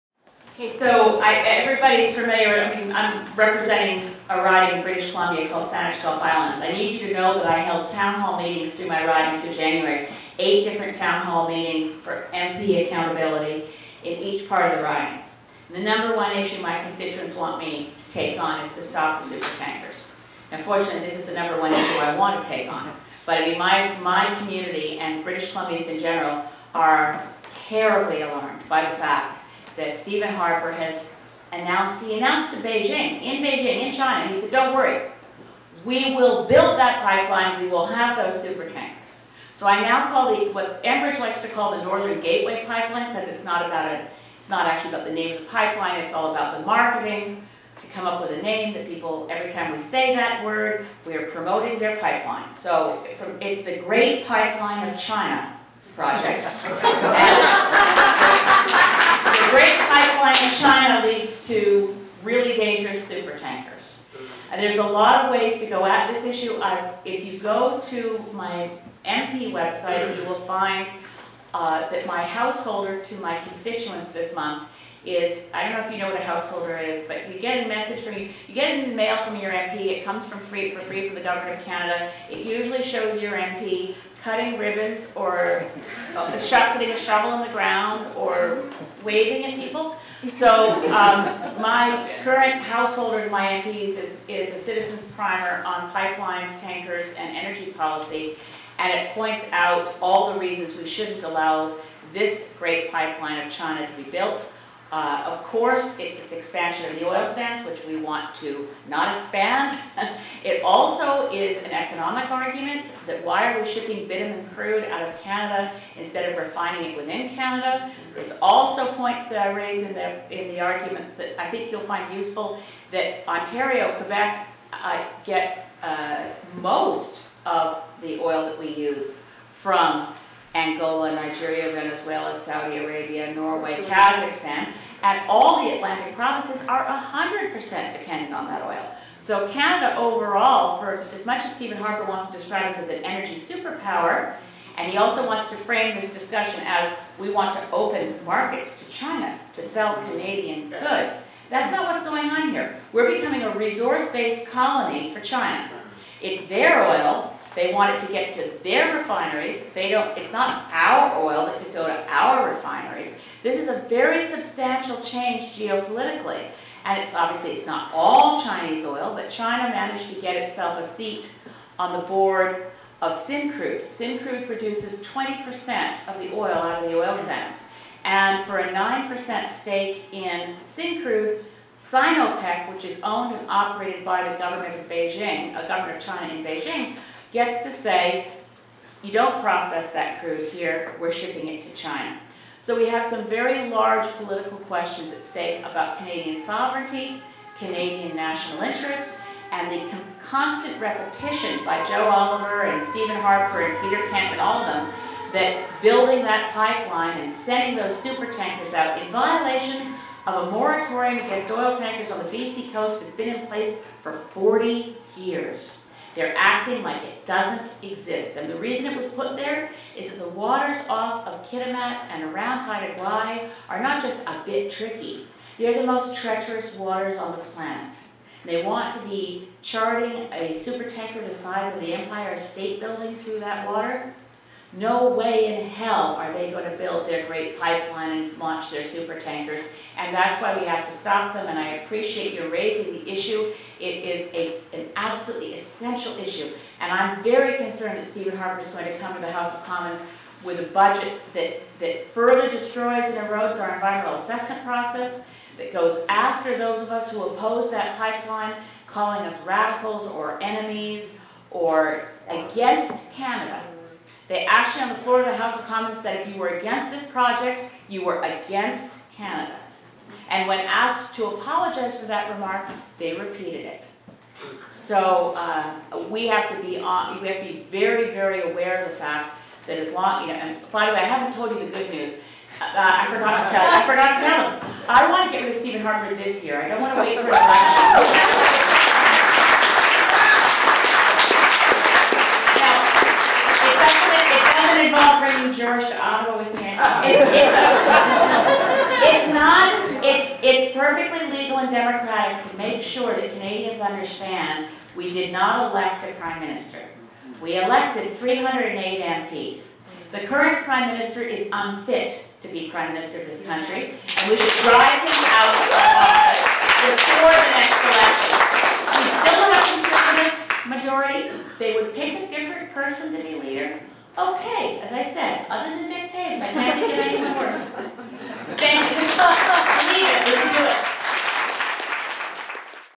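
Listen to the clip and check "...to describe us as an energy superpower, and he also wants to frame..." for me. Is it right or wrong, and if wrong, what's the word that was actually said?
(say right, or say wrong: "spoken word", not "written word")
right.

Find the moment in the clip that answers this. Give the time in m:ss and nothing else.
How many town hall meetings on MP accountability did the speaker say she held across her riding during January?
0:10.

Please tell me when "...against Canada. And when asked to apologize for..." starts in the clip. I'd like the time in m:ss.
4:28.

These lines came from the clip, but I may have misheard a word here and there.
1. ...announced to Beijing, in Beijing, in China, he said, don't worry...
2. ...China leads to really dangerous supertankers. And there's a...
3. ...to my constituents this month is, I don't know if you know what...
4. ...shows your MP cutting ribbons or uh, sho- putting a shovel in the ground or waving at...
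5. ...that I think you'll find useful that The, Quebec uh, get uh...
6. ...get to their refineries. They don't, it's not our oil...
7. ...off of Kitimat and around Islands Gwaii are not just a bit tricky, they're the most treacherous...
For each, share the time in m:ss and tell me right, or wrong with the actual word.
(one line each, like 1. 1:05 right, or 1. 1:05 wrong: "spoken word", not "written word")
1. 0:32 right
2. 1:00 right
3. 1:13 right
4. 1:22 right
5. 2:01 wrong: "Ontario", not "The"
6. 2:38 right
7. 3:40 wrong: "Haida", not "Islands".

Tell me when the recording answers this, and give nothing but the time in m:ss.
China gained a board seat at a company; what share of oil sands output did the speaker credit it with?
2:55.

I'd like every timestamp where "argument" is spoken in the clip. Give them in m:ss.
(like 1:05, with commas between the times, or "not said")
1:52, 2:00.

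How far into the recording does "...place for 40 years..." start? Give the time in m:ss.
3:33.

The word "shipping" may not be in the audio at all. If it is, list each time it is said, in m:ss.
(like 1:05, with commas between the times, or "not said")
1:53, 3:11.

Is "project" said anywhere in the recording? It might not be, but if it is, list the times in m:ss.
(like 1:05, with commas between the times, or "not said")
0:55, 4:27.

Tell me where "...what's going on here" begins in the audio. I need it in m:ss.
2:31.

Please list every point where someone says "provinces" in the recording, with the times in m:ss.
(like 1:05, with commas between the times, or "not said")
2:16.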